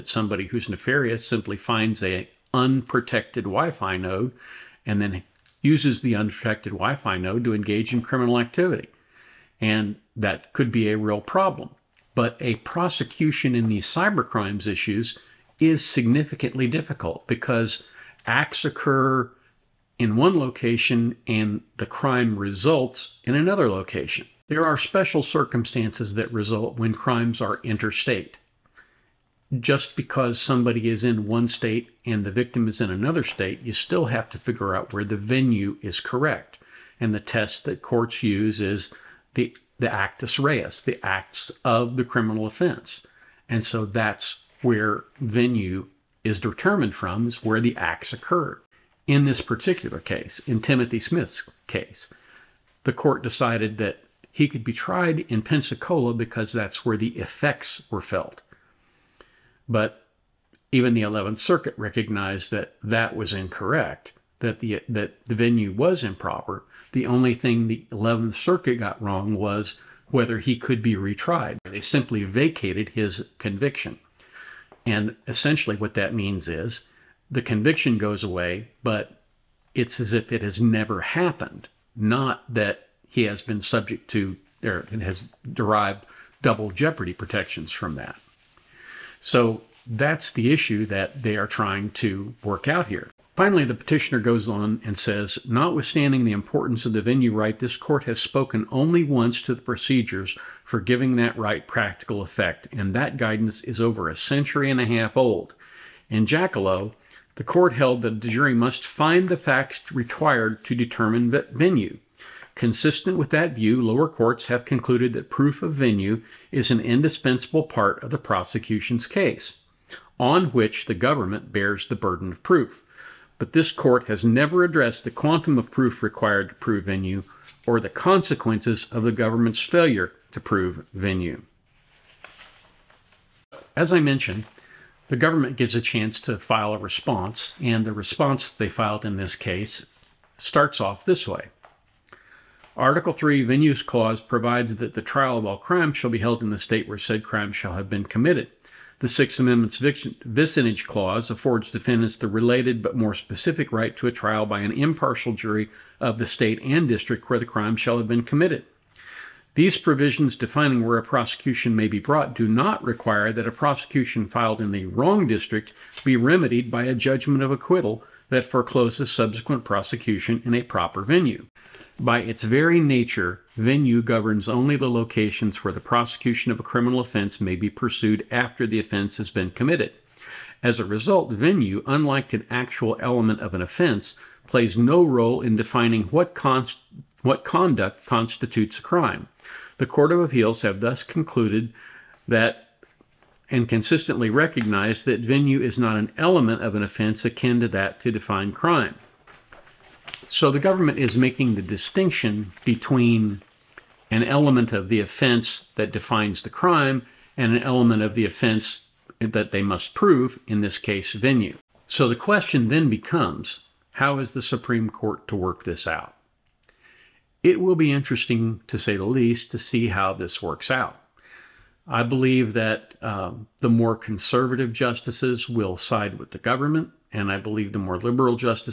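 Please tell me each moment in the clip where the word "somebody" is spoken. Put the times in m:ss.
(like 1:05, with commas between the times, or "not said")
0:00, 0:30.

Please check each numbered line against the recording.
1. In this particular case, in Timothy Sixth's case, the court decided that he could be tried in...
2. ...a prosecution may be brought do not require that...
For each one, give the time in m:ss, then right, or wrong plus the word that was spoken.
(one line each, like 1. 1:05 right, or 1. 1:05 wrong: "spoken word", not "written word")
1. 0:49 wrong: "Smith", not "Sixth"
2. 2:40 right.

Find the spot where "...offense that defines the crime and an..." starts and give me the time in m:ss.
3:24.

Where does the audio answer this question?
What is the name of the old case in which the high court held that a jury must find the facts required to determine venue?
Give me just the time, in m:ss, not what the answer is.
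1:46.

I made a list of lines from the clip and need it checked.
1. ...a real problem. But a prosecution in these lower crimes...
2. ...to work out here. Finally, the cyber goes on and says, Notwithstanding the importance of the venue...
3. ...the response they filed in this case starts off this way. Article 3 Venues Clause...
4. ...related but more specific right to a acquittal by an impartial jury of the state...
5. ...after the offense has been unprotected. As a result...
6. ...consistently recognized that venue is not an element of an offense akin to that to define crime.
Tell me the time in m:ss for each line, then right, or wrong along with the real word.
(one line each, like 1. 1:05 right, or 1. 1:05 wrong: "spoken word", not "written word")
1. 0:10 wrong: "cyber", not "lower"
2. 1:31 wrong: "petitioner", not "cyber"
3. 2:17 right
4. 2:32 wrong: "trial", not "acquittal"
5. 2:58 wrong: "committed", not "unprotected"
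6. 3:13 right.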